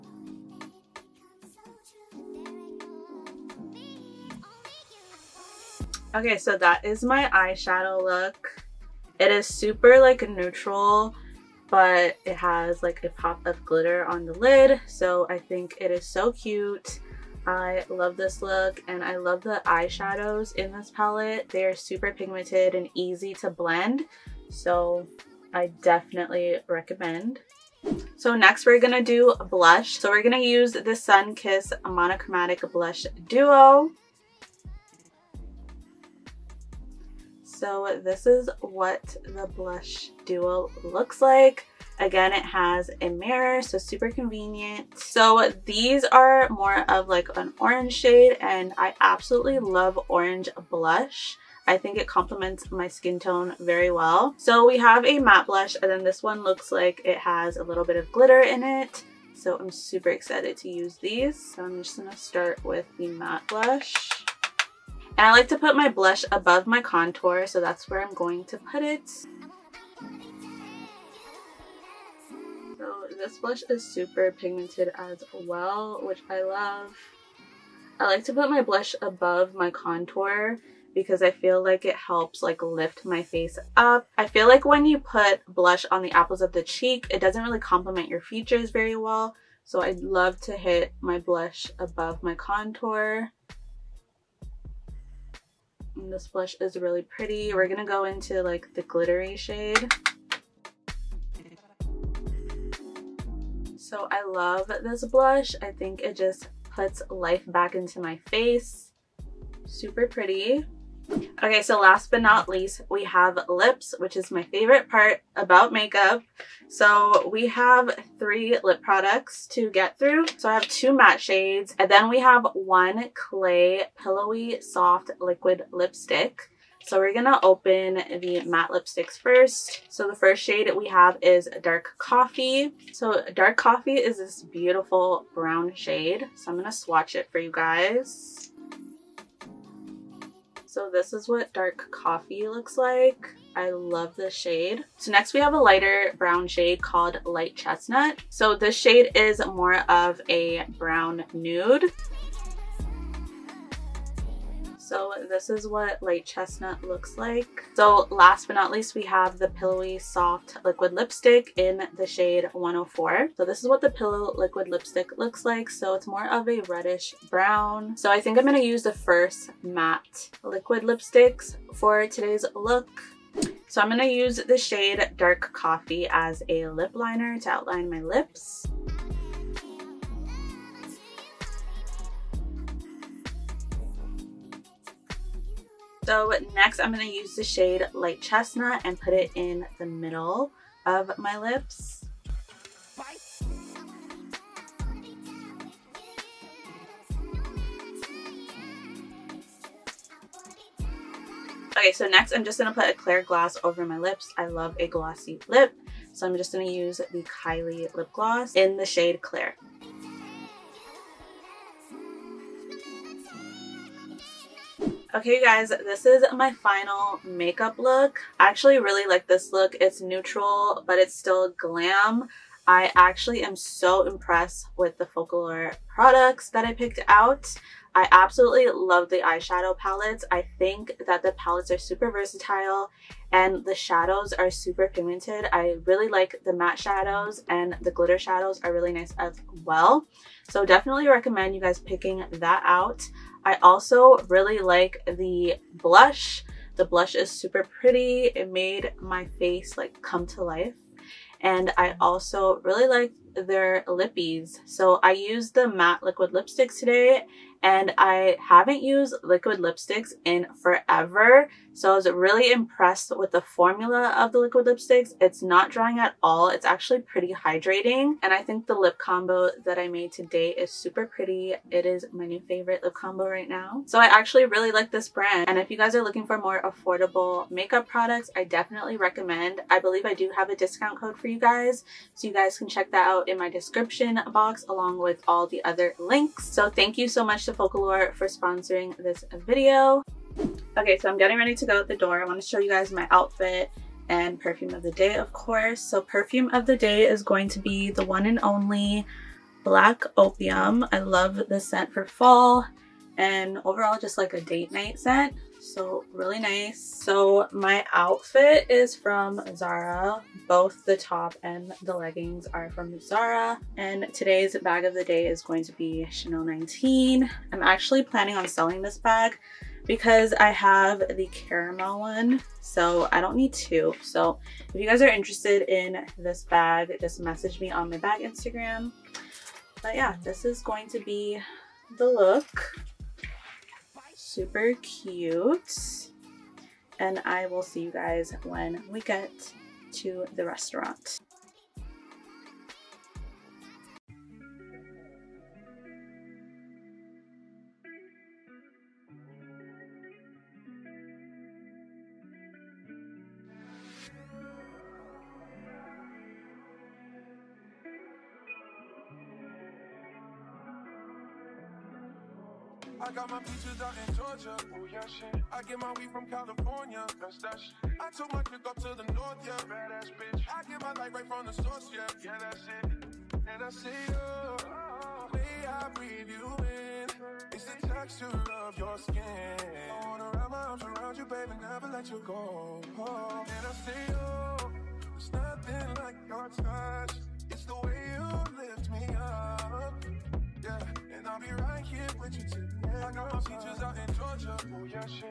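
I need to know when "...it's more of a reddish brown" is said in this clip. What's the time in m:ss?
2:45.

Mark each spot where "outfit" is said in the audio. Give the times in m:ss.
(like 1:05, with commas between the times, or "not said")
4:53, 5:07.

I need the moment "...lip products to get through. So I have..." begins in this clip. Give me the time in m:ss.
1:58.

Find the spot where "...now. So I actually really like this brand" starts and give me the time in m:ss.
4:33.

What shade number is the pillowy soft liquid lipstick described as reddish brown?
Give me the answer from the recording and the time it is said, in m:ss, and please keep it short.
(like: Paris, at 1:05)
104, at 2:42.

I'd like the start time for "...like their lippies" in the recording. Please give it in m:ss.
4:12.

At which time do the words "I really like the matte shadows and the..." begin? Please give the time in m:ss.
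3:55.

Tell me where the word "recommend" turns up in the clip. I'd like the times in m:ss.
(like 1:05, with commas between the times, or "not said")
0:26, 4:01, 4:38.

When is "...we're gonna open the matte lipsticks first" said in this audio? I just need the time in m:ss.
2:06.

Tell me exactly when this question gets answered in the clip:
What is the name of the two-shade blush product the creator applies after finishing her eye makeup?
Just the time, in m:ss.
0:30.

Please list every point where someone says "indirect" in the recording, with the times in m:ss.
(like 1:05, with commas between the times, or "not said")
not said.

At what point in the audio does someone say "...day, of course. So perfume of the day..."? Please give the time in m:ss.
4:54.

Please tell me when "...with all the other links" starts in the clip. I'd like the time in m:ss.
4:44.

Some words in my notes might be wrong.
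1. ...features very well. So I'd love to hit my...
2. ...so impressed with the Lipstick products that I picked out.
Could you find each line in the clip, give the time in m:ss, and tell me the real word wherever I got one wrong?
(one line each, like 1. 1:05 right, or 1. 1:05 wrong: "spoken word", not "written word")
1. 1:28 right
2. 3:43 wrong: "Focallure", not "Lipstick".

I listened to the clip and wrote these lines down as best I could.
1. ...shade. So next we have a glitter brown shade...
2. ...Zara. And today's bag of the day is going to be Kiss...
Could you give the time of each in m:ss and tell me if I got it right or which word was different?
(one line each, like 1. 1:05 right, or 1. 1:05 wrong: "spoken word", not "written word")
1. 2:24 wrong: "lighter", not "glitter"
2. 5:13 wrong: "Chanel", not "Kiss".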